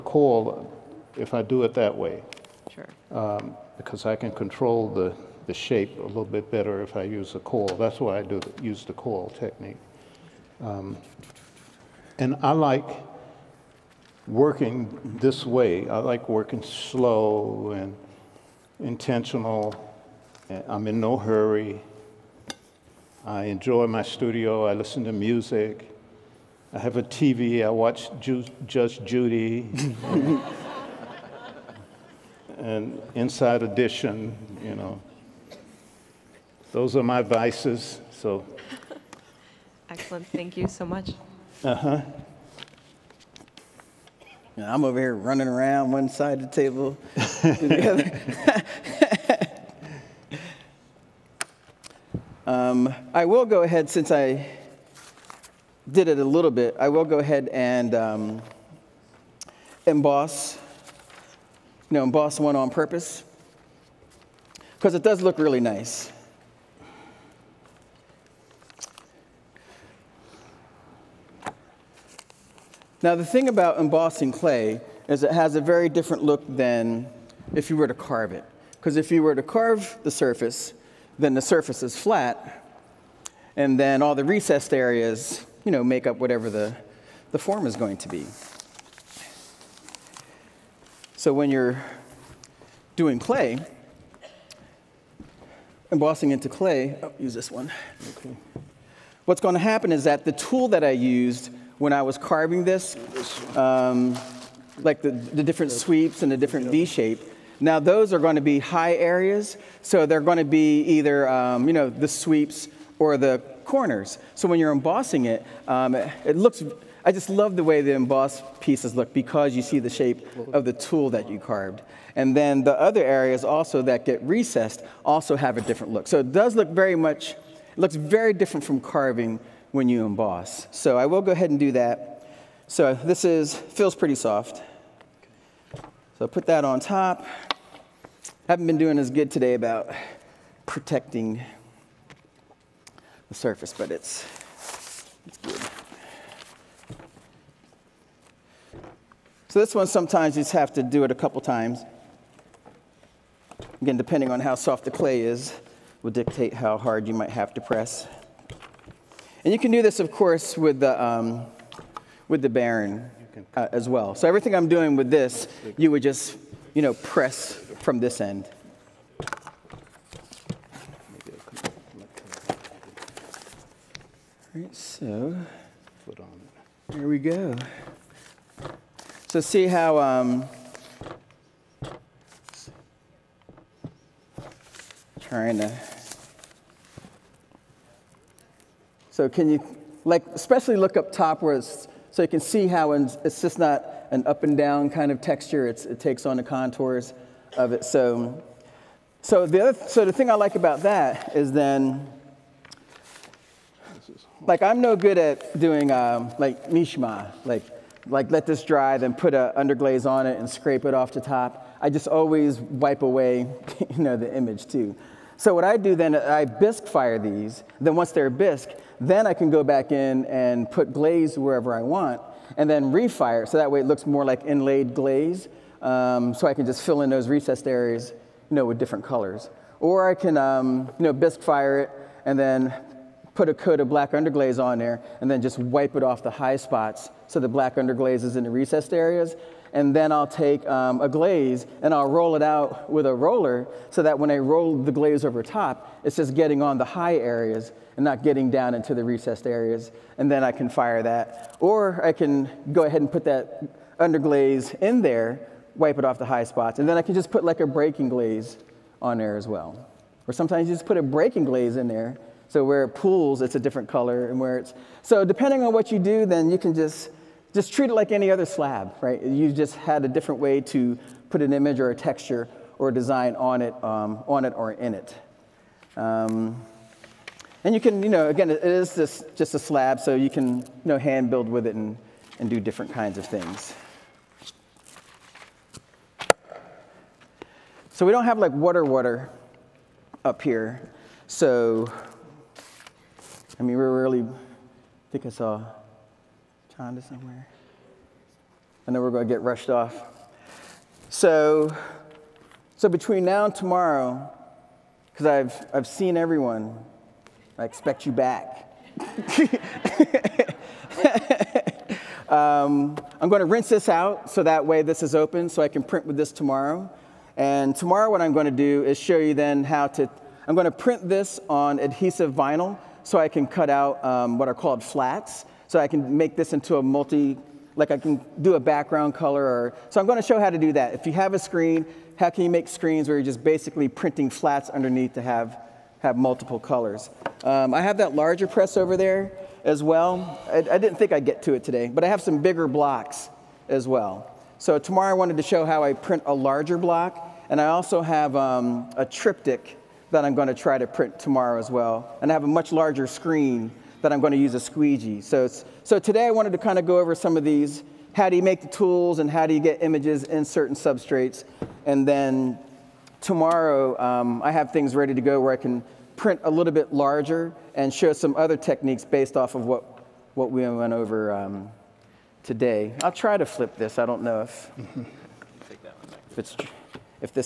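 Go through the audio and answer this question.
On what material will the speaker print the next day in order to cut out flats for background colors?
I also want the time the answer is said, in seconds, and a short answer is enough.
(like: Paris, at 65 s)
adhesive vinyl, at 321 s.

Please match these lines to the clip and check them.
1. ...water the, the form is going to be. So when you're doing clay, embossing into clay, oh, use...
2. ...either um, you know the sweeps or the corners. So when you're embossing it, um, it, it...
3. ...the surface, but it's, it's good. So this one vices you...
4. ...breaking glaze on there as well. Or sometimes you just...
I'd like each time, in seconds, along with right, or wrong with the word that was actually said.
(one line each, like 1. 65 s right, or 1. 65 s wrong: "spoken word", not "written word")
1. 86 s wrong: "whatever", not "water"
2. 110 s right
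3. 143 s wrong: "sometimes", not "vices"
4. 257 s right.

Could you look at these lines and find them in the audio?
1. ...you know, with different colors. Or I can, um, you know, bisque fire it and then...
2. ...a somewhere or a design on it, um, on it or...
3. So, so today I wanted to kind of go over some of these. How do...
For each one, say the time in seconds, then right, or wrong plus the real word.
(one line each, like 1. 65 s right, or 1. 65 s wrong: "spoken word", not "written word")
1. 228 s right
2. 271 s wrong: "texture", not "somewhere"
3. 355 s right.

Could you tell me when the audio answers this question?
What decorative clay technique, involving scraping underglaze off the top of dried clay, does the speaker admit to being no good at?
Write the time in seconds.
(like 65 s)
206 s.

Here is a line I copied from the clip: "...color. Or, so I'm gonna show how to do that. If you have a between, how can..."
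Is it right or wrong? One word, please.
wrong.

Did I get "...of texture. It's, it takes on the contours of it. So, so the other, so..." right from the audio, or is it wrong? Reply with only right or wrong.
right.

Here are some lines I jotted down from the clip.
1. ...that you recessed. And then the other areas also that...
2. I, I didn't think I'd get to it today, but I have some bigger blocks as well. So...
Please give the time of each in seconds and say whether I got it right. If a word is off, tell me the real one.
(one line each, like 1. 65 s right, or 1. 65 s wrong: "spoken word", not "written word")
1. 121 s wrong: "carved", not "recessed"
2. 340 s right.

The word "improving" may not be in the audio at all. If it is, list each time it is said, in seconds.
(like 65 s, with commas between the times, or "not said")
not said.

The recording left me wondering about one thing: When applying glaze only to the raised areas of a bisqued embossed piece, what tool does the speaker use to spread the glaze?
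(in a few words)
roller.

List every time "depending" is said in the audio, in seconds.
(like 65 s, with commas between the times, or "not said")
153 s, 265 s.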